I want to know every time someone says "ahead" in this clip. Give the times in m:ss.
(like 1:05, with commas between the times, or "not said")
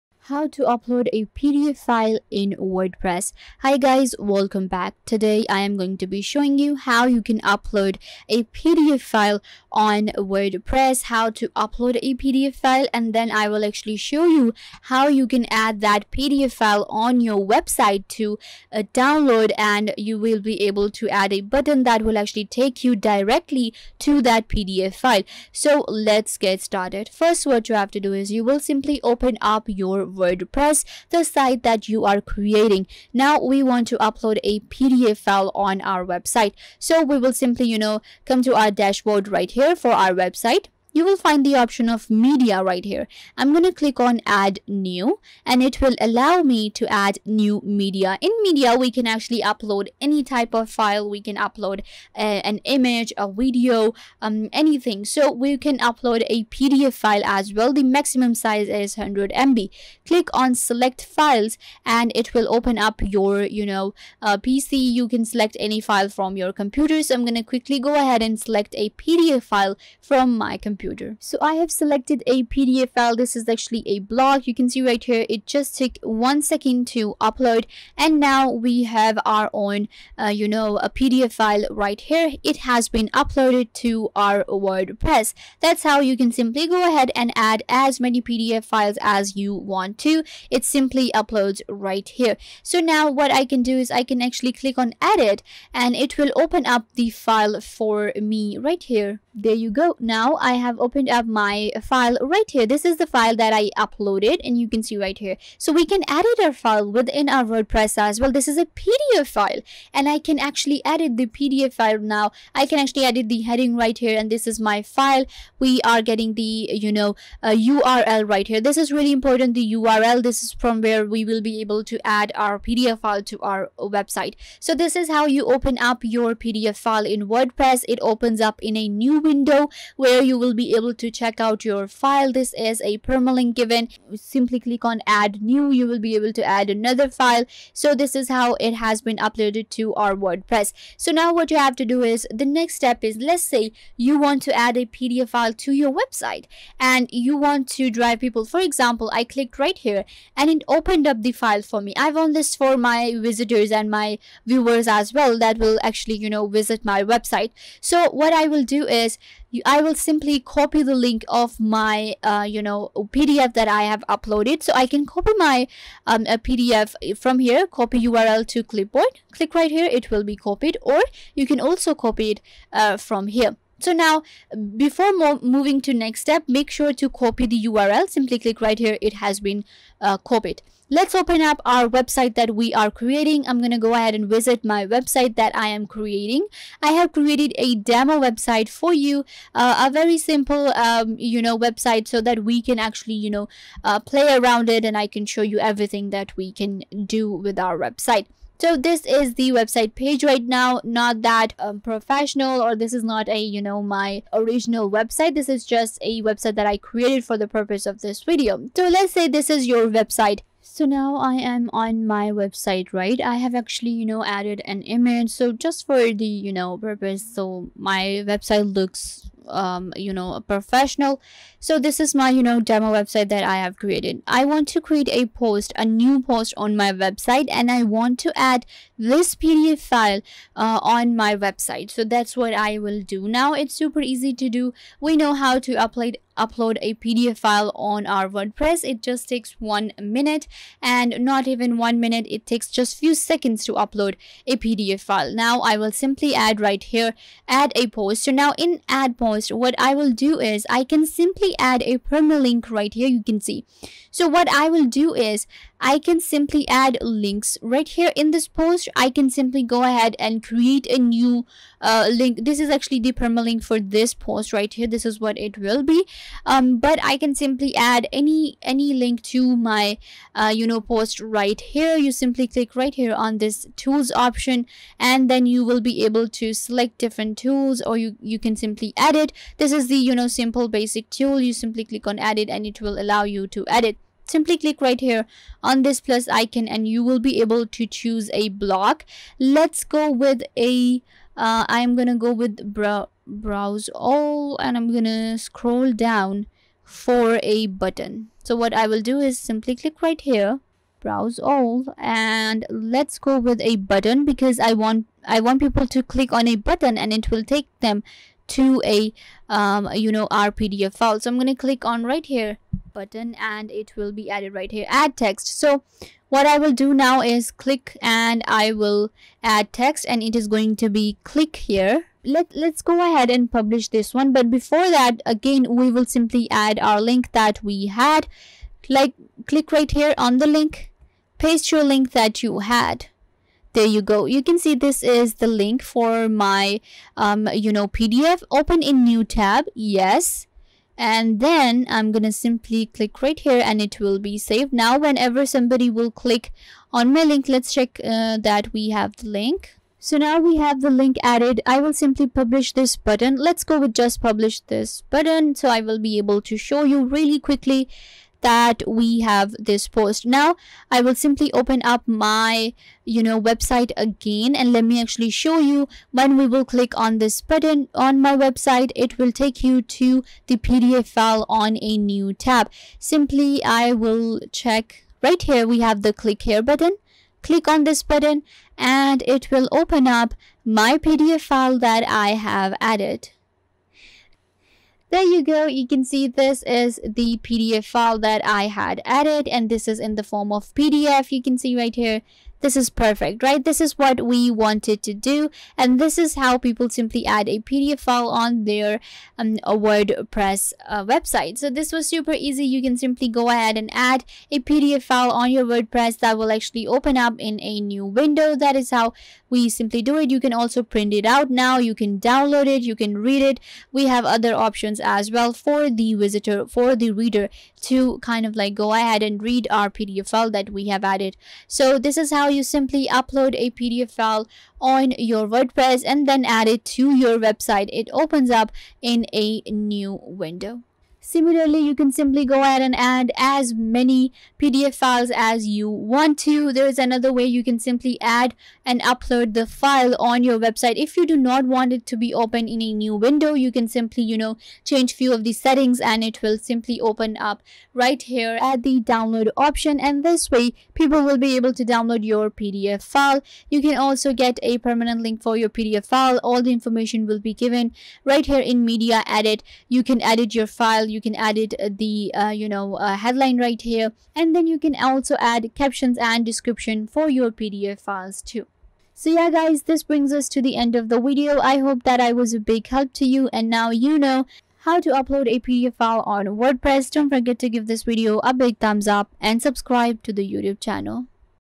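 1:07, 1:26, 3:03, 4:19, 5:23, 6:43, 6:58, 7:12.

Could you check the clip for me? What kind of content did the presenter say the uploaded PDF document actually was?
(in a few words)
a blog.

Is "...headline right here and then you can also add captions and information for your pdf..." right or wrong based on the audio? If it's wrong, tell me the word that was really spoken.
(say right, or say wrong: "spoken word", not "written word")
wrong: "description", not "information".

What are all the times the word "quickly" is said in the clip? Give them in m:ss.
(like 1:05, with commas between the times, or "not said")
1:07, 5:57.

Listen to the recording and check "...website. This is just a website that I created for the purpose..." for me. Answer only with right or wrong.
right.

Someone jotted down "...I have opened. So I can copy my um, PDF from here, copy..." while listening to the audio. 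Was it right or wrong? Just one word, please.
wrong.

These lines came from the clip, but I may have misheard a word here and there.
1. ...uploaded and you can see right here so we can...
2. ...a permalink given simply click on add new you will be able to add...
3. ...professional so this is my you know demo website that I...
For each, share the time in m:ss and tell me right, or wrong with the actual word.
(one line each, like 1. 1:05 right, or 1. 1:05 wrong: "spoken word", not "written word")
1. 1:43 right
2. 2:12 right
3. 3:40 right.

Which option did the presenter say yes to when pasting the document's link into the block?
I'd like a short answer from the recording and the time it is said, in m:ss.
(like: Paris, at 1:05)
Open in new tab, at 5:38.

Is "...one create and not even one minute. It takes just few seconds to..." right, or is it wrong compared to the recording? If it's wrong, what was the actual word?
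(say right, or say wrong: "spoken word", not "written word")
wrong: "minute", not "create".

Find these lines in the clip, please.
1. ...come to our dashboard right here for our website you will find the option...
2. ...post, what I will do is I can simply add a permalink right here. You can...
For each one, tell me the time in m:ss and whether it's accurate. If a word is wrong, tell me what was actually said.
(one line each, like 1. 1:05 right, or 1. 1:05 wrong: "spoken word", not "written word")
1. 0:38 right
2. 4:09 right.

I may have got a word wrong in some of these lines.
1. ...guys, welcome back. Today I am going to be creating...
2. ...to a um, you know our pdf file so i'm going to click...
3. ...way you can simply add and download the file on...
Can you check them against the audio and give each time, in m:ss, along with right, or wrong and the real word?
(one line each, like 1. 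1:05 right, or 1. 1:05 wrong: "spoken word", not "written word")
1. 0:03 wrong: "showing", not "creating"
2. 5:08 right
3. 7:17 wrong: "upload", not "download".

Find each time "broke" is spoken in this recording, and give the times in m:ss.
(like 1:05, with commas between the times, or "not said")
not said.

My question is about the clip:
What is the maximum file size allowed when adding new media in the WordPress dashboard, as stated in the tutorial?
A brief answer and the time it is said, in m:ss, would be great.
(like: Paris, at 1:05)
100 MB, at 0:58.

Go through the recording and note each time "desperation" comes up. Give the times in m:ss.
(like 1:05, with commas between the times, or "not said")
not said.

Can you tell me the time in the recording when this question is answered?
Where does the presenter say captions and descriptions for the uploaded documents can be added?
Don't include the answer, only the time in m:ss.
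7:38.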